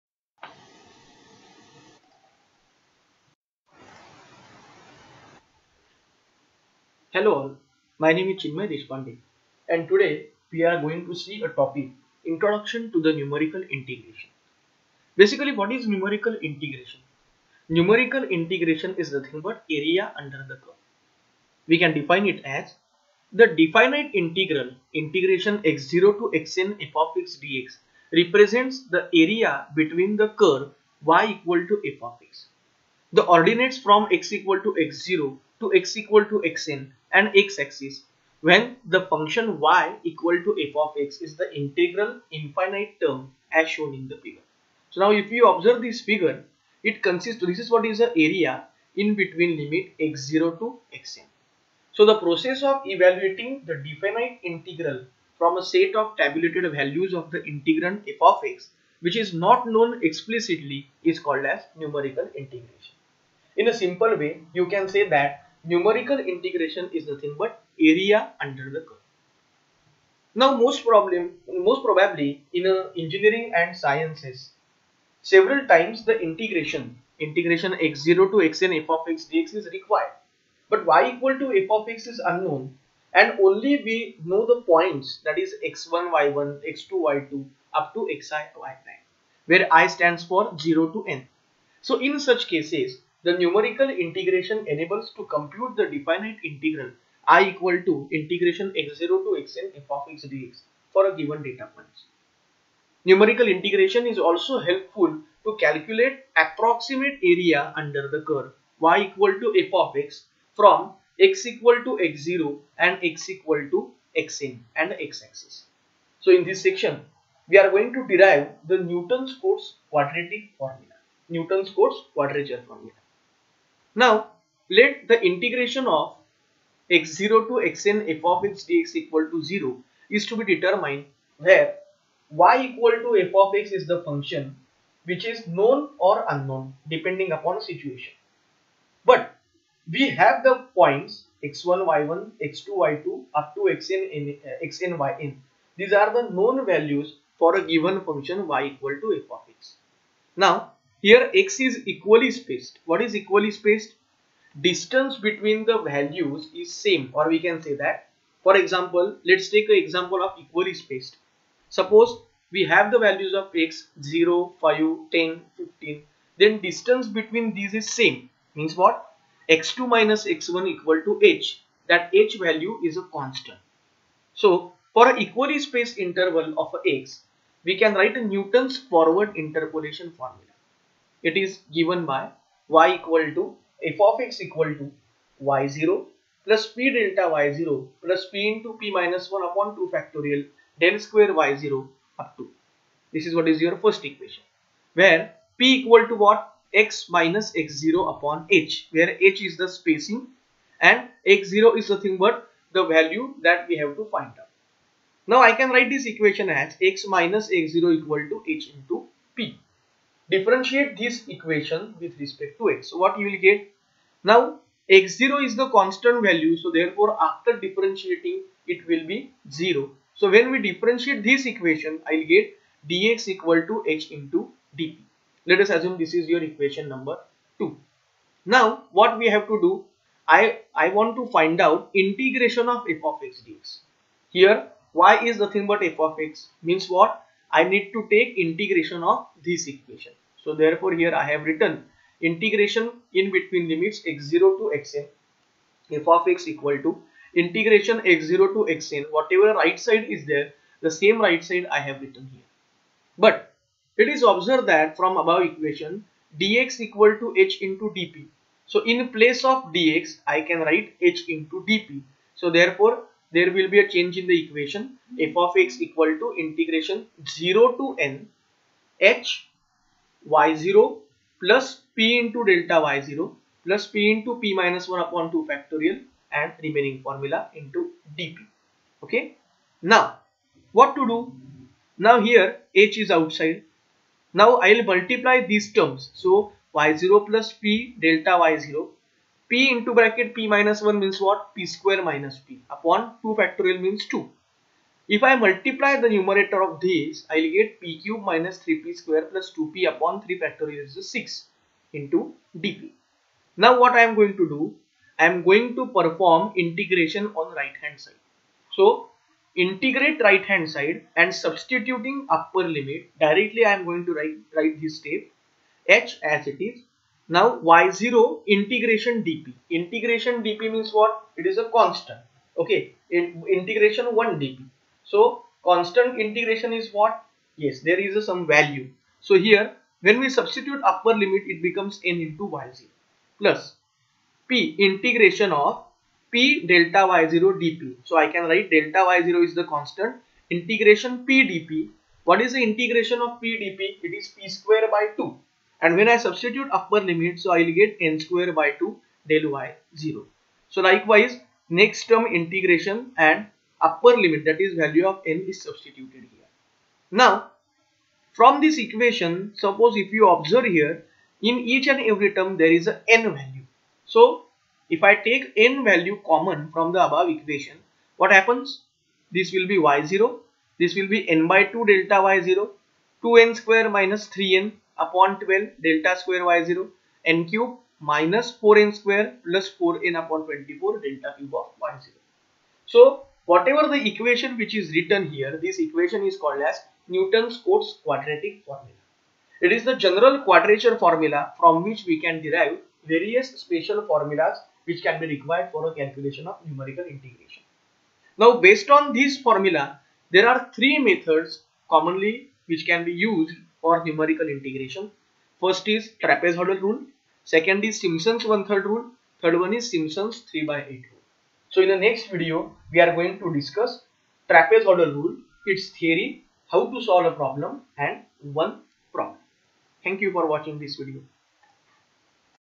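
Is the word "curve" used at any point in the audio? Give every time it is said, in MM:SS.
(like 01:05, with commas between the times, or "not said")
00:20, 00:30, 01:08, 01:48.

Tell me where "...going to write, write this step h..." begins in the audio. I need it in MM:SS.
05:13.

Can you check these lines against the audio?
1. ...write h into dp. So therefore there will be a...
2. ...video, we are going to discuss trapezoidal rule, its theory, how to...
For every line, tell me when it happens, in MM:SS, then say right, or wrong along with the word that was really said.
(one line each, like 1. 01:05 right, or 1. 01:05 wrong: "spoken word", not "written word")
1. 04:20 right
2. 06:52 right.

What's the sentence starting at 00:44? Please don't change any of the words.
So now if you observe this figure, it consists, this is what is the area in between limit x0 to xn.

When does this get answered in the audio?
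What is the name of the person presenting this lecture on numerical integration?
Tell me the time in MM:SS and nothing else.
00:08.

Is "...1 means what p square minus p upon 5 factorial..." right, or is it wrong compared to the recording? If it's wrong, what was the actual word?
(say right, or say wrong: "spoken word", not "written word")
wrong: "2", not "5".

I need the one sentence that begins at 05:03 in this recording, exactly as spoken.
Now what I am going to do, I am going to perform integration on right hand side.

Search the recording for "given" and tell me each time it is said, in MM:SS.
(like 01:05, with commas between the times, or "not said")
01:41, 02:27, 03:01.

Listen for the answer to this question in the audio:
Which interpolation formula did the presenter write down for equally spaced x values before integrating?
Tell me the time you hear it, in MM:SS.
02:58.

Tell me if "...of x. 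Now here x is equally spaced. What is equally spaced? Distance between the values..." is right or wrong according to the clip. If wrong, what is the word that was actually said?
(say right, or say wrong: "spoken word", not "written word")
right.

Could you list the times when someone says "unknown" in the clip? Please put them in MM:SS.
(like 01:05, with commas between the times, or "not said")
01:22, 02:16.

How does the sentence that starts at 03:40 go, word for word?
So when we differentiate this equation I will get dx equal to h into dp.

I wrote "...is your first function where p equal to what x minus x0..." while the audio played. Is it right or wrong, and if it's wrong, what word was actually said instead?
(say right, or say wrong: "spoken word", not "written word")
wrong: "equation", not "function".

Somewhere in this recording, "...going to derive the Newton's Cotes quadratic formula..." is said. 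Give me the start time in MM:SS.
01:57.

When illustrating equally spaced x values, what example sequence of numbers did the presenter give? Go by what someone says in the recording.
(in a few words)
0, 5, 10, 15.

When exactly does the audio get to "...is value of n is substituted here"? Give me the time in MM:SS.
05:54.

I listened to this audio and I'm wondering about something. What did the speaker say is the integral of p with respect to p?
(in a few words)
p square by 2.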